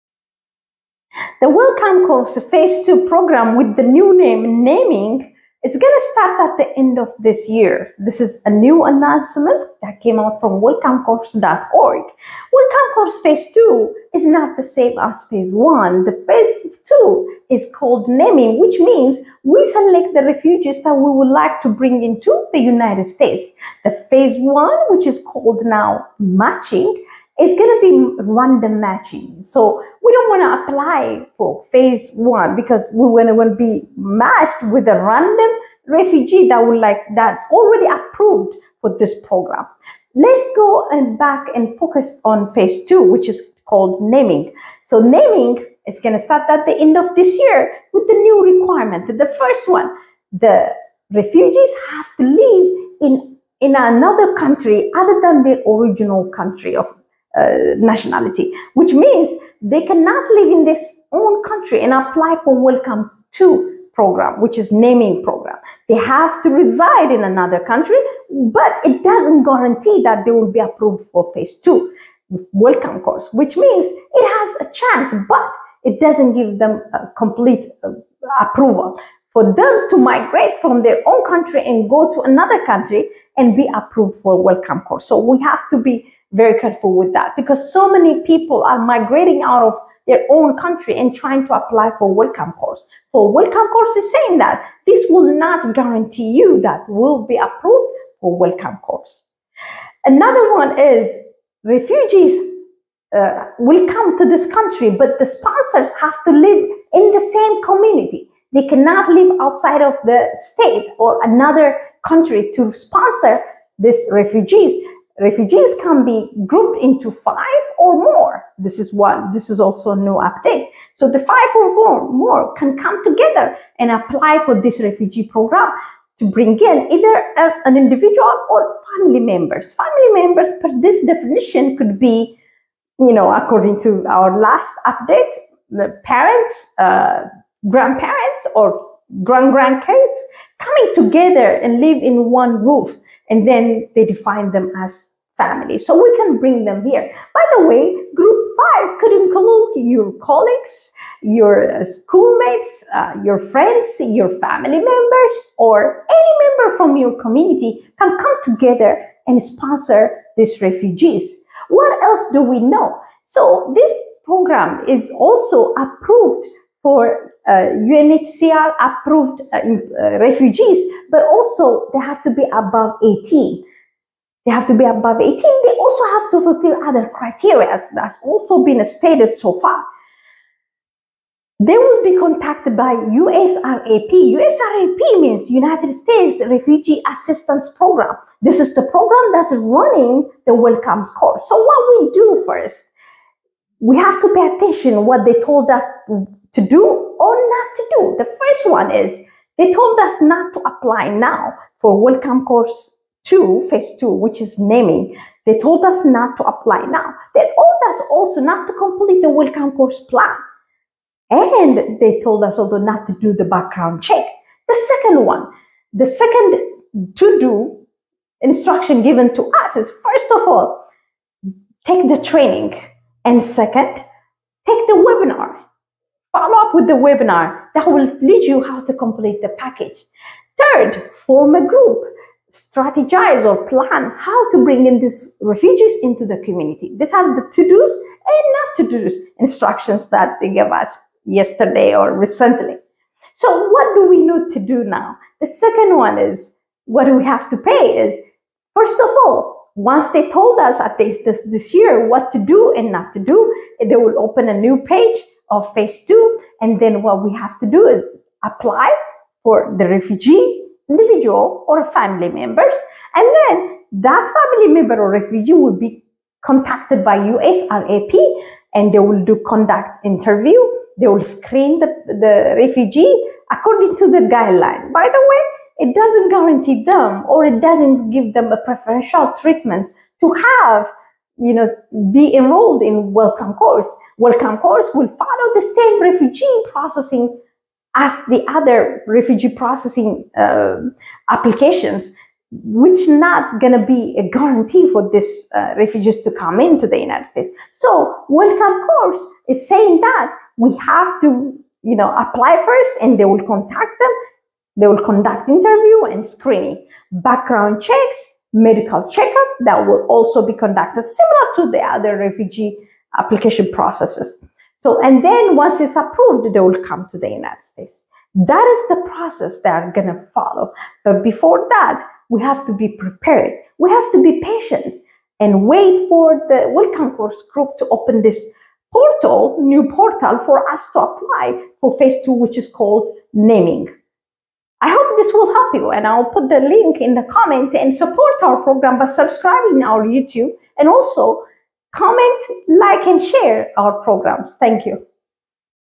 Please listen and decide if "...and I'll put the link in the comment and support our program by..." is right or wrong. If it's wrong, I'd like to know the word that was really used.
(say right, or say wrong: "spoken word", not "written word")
right.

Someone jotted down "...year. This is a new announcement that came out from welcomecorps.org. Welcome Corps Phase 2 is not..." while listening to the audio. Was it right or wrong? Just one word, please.
right.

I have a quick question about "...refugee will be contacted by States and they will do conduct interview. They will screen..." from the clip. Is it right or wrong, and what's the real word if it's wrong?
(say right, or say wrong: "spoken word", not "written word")
wrong: "USRAP", not "States".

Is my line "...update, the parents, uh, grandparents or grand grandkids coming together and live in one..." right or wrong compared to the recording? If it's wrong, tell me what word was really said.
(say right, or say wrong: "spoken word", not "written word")
right.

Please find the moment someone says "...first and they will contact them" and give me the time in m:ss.
5:02.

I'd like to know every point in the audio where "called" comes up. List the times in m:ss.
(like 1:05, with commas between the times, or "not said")
0:17, 0:25, 0:43, 5:32.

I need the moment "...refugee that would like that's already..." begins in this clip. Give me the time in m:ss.
0:35.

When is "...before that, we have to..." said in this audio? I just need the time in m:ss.
5:21.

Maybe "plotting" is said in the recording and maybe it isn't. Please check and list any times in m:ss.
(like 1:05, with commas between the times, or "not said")
not said.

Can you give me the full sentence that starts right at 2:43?
So this program is also approved for uh, UNHCR approved uh, uh, refugees, but also they have to be above 18.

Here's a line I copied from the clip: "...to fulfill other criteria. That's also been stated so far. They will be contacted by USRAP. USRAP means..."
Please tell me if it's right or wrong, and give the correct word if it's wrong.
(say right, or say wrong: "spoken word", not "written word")
right.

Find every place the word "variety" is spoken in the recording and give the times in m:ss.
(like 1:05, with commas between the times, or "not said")
not said.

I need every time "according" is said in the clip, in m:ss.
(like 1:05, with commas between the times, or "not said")
2:13, 4:33.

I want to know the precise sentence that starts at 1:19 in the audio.
For them to migrate from their own country and go to another country and be approved for welcome corps.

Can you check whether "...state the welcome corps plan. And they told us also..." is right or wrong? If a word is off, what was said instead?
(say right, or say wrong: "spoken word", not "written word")
wrong: "complete", not "state".